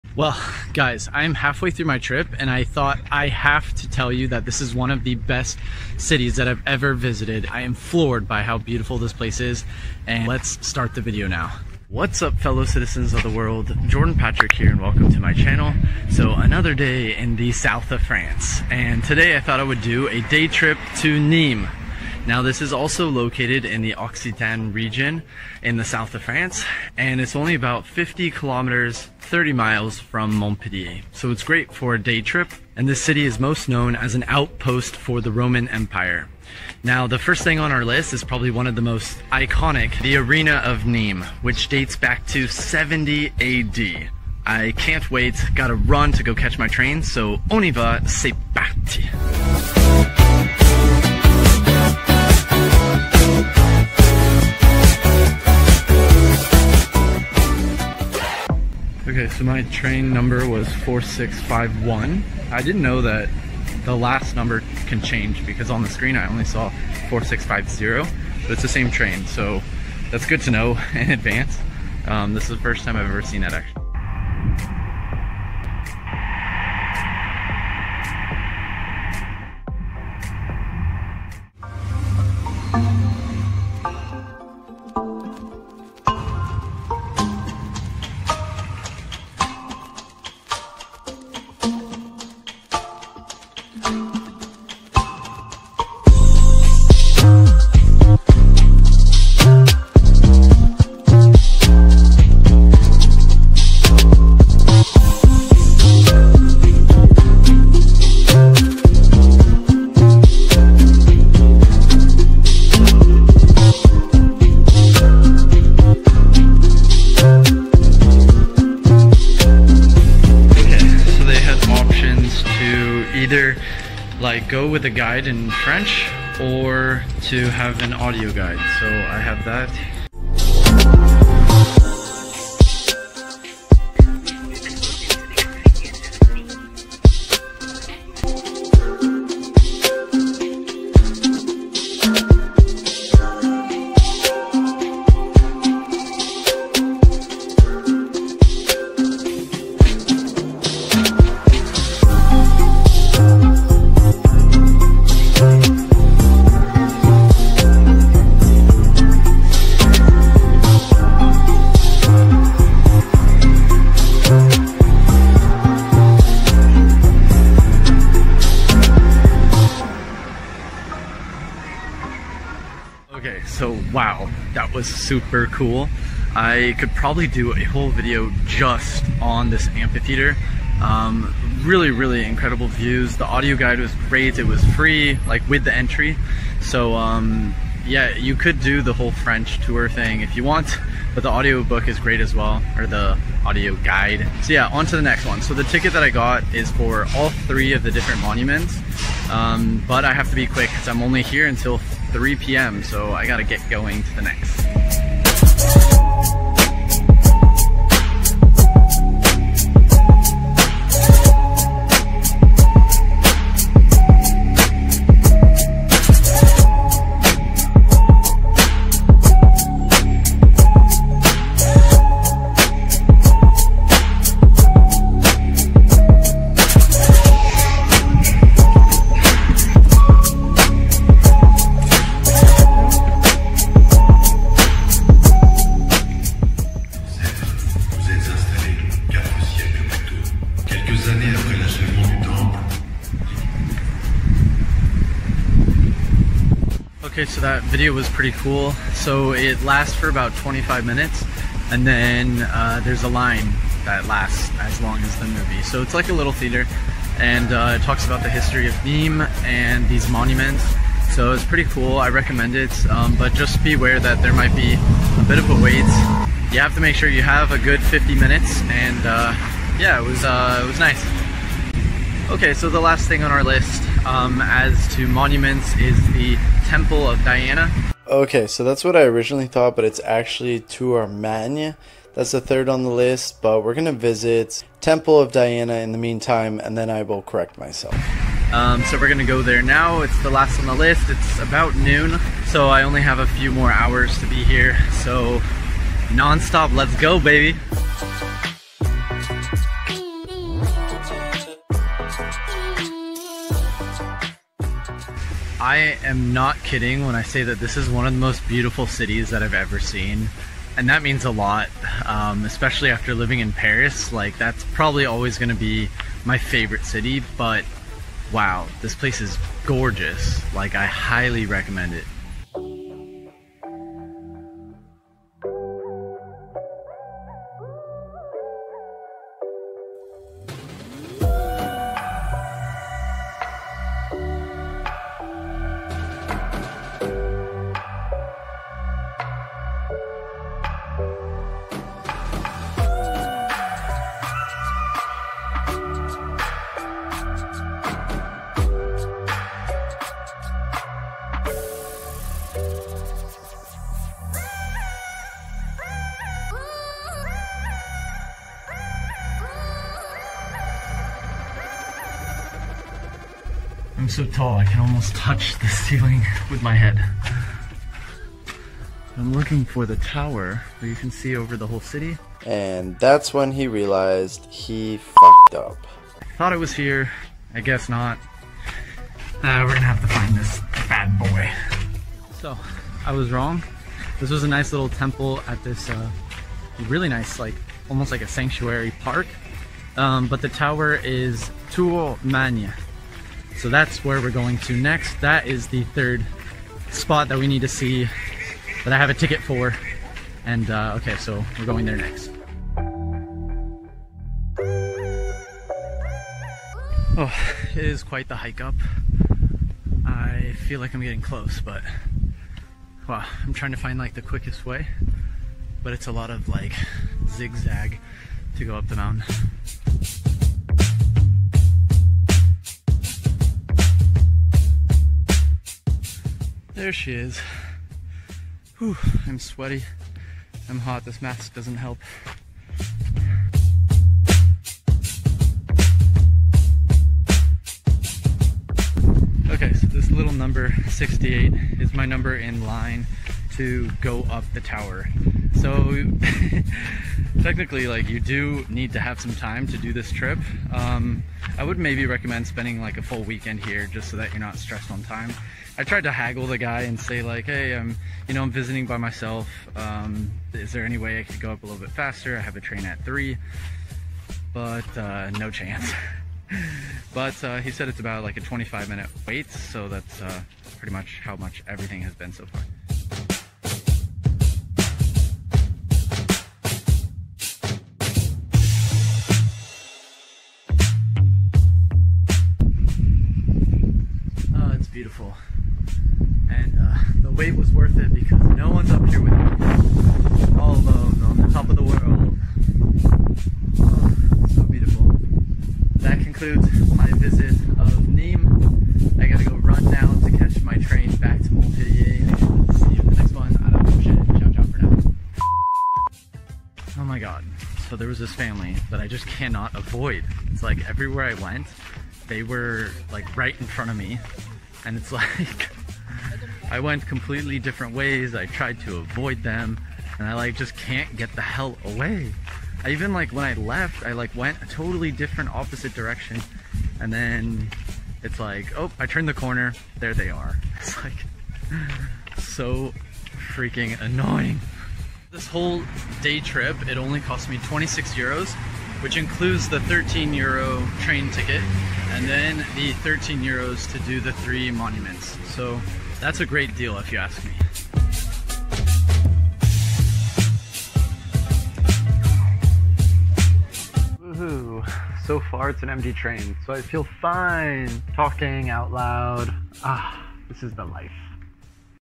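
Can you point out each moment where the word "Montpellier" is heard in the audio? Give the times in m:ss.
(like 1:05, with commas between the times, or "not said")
0:30, 8:21.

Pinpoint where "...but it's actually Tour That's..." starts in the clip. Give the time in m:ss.
4:39.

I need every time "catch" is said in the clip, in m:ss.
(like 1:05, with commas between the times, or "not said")
0:46, 8:20.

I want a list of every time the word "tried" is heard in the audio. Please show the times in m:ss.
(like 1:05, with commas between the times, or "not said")
7:35, 8:38.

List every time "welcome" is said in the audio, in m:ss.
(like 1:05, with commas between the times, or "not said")
0:14.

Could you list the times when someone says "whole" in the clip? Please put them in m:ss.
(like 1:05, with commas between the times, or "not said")
2:57, 3:08, 6:11, 8:55.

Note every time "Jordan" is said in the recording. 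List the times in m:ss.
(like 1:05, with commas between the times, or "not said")
0:13.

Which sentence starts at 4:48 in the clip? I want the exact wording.
Um, so we're going to go there now.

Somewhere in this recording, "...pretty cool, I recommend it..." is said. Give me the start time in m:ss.
4:21.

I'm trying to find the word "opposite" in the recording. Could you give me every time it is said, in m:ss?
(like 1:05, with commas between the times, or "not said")
8:45.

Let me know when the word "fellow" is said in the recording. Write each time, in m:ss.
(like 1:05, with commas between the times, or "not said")
0:12.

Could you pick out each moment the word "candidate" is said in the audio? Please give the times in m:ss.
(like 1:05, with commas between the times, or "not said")
not said.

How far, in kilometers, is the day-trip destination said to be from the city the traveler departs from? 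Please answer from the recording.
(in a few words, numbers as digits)
50.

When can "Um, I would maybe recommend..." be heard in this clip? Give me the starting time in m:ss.
7:30.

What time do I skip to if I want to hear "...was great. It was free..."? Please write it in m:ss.
3:03.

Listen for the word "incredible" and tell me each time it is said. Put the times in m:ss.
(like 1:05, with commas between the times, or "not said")
3:02.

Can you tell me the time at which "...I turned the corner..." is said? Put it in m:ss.
8:48.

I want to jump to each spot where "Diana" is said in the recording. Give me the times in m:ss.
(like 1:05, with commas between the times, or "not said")
4:37, 4:45.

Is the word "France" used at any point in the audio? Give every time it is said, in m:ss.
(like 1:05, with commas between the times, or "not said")
0:18, 0:26.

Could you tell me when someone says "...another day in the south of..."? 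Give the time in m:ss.
0:16.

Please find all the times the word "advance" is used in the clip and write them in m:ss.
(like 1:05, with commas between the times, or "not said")
1:11.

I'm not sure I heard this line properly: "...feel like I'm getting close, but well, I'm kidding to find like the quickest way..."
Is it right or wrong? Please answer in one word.
wrong.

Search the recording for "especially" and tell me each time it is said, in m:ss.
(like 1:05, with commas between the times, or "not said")
5:12.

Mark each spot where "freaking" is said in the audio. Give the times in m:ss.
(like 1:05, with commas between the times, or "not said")
8:53.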